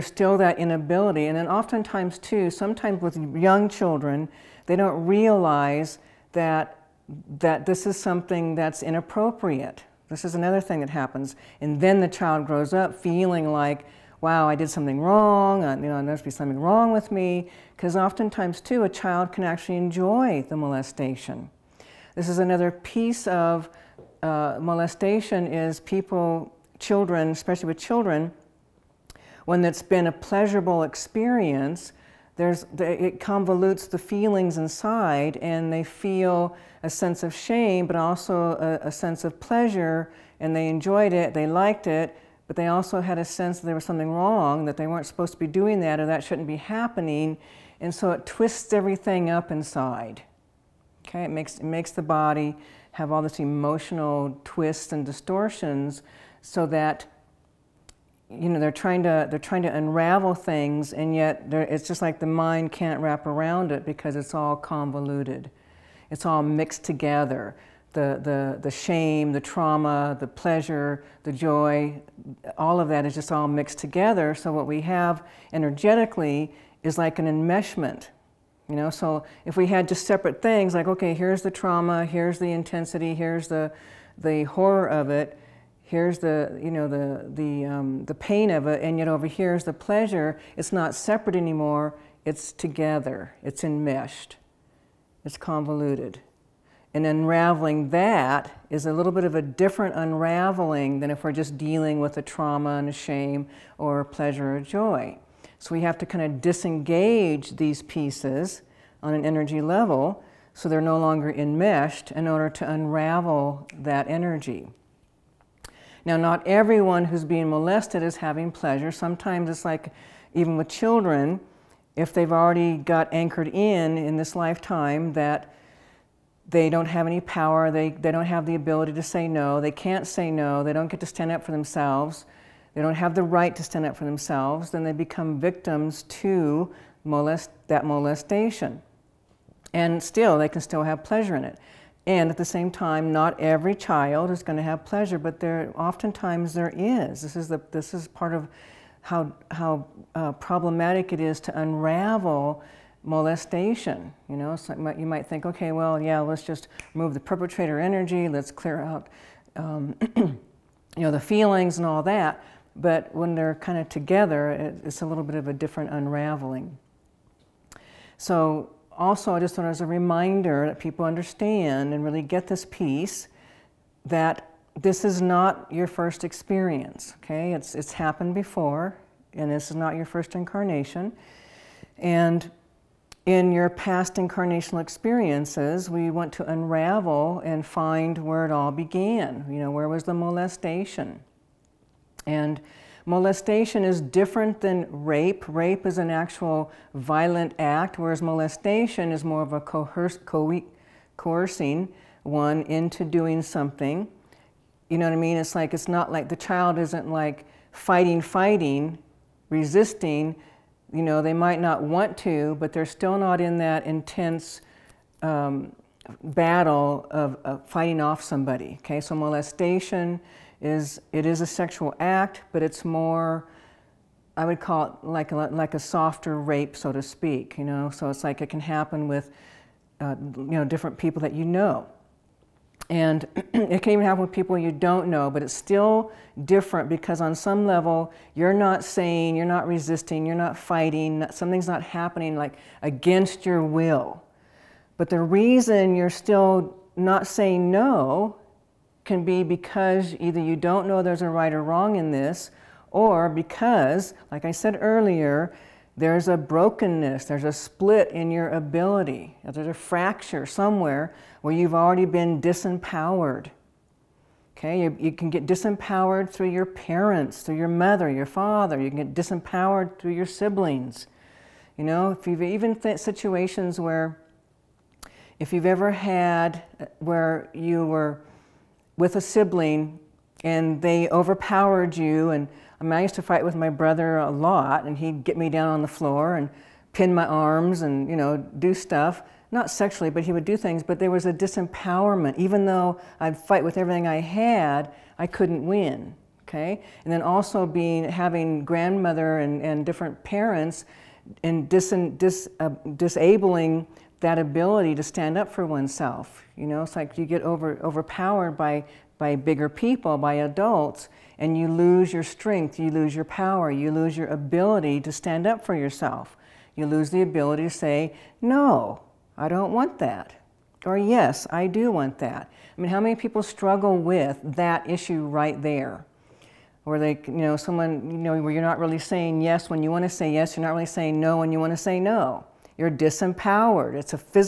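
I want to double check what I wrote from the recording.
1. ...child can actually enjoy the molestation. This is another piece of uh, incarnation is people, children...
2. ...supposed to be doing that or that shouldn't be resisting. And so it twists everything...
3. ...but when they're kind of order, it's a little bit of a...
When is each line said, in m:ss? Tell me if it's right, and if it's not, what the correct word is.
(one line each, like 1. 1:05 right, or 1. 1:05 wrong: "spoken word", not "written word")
1. 0:18 wrong: "molestation", not "incarnation"
2. 0:45 wrong: "happening", not "resisting"
3. 2:42 wrong: "together", not "order".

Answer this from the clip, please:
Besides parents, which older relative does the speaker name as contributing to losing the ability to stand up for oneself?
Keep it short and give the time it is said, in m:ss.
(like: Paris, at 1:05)
grandmother, at 4:58.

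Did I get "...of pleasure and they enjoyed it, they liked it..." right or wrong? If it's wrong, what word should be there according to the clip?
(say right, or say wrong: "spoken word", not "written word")
right.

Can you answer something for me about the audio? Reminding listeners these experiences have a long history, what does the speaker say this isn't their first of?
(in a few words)
incarnation.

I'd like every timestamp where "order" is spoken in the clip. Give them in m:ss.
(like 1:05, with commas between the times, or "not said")
1:52.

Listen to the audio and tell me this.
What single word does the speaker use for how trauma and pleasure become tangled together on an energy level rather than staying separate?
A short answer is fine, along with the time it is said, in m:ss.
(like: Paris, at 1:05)
enmeshment, at 1:17.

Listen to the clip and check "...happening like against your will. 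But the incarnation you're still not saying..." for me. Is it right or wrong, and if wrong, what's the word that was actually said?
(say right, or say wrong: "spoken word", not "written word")
wrong: "reason", not "incarnation".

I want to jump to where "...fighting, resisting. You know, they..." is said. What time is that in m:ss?
3:28.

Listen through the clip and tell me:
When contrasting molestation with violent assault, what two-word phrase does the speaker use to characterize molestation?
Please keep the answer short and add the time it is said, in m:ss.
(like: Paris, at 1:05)
softer rape, at 3:45.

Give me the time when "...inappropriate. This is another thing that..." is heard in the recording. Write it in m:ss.
0:08.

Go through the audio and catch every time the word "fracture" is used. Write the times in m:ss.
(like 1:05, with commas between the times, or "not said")
4:19.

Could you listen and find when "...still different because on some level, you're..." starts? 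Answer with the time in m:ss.
3:55.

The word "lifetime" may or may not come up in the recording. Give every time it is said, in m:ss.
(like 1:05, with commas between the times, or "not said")
2:04.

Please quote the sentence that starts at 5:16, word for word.
You lose the ability to say, no, I don't want that.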